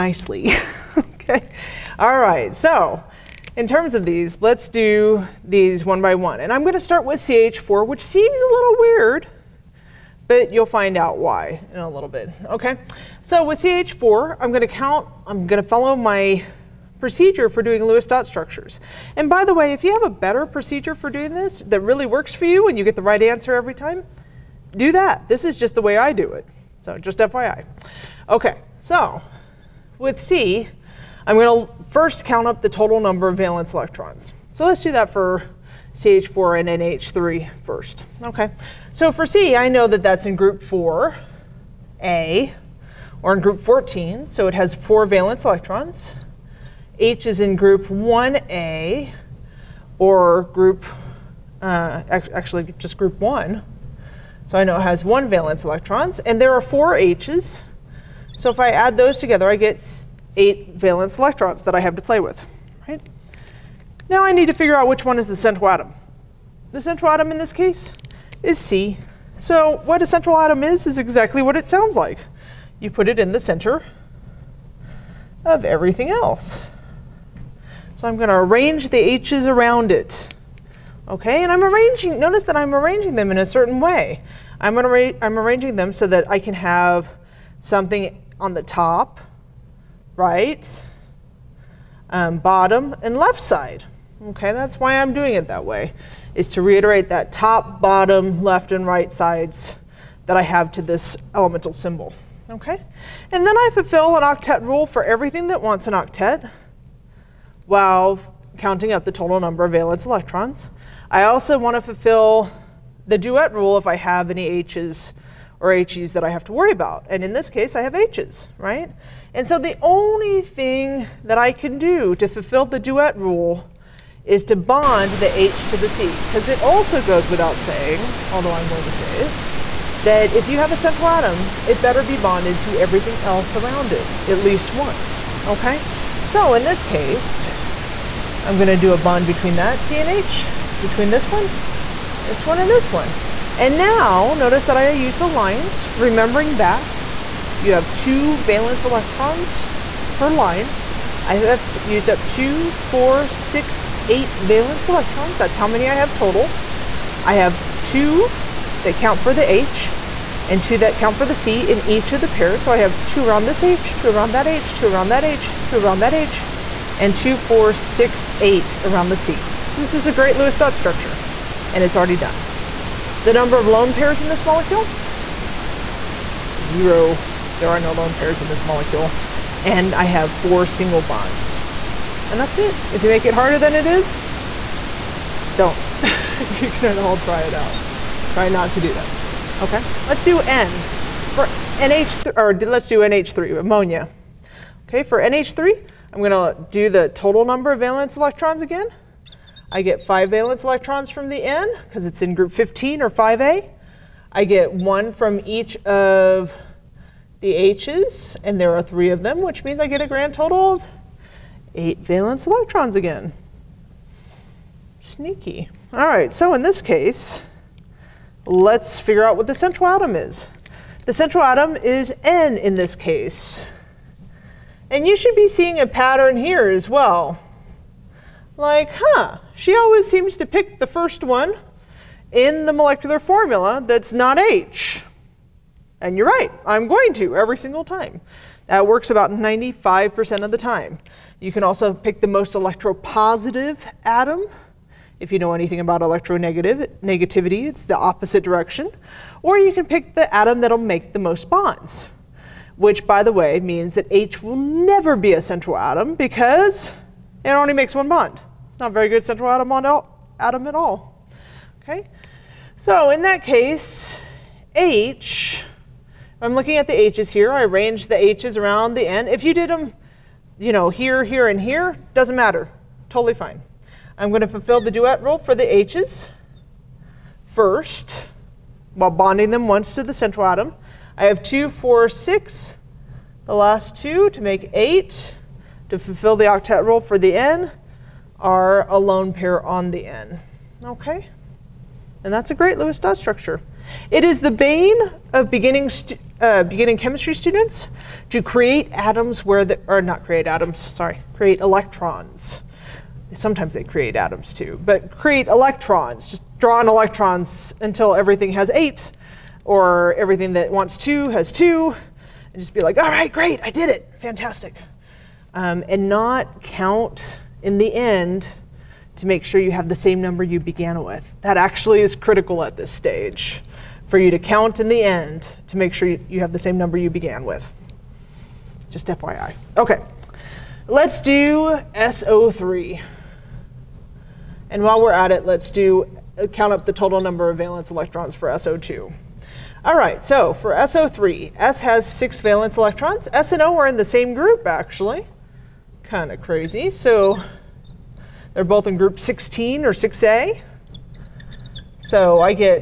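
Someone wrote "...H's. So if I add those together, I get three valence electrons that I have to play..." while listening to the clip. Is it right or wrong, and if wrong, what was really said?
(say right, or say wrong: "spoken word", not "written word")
wrong: "eight", not "three".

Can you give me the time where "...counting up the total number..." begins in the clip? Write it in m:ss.
1:48.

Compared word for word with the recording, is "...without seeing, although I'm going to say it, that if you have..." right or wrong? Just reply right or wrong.
wrong.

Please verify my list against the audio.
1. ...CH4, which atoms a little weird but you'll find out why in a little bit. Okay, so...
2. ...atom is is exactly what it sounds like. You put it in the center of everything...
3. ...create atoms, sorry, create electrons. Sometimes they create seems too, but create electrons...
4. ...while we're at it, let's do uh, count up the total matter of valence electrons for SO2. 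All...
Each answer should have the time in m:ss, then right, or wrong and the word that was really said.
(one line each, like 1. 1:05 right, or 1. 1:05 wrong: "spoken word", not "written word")
1. 0:07 wrong: "seems", not "atoms"
2. 1:10 right
3. 5:00 wrong: "atoms", not "seems"
4. 5:34 wrong: "number", not "matter".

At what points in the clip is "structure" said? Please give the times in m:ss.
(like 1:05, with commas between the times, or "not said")
0:18, 2:50, 4:53.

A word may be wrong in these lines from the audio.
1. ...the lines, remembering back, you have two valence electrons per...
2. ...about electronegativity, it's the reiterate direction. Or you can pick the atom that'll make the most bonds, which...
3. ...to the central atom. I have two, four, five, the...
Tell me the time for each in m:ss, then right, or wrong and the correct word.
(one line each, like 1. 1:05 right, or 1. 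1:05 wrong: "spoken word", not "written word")
1. 2:25 right
2. 4:05 wrong: "opposite", not "reiterate"
3. 4:39 wrong: "six", not "five".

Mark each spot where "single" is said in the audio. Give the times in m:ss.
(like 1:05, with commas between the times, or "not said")
3:00, 3:57.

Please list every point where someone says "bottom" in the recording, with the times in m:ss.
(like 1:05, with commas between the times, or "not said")
1:32, 1:37.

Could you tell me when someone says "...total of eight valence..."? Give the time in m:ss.
3:30.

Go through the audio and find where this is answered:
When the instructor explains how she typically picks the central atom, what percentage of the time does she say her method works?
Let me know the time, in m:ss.
3:59.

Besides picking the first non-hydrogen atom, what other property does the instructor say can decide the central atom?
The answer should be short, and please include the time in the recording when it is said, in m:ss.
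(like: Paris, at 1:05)
electropositive, at 4:02.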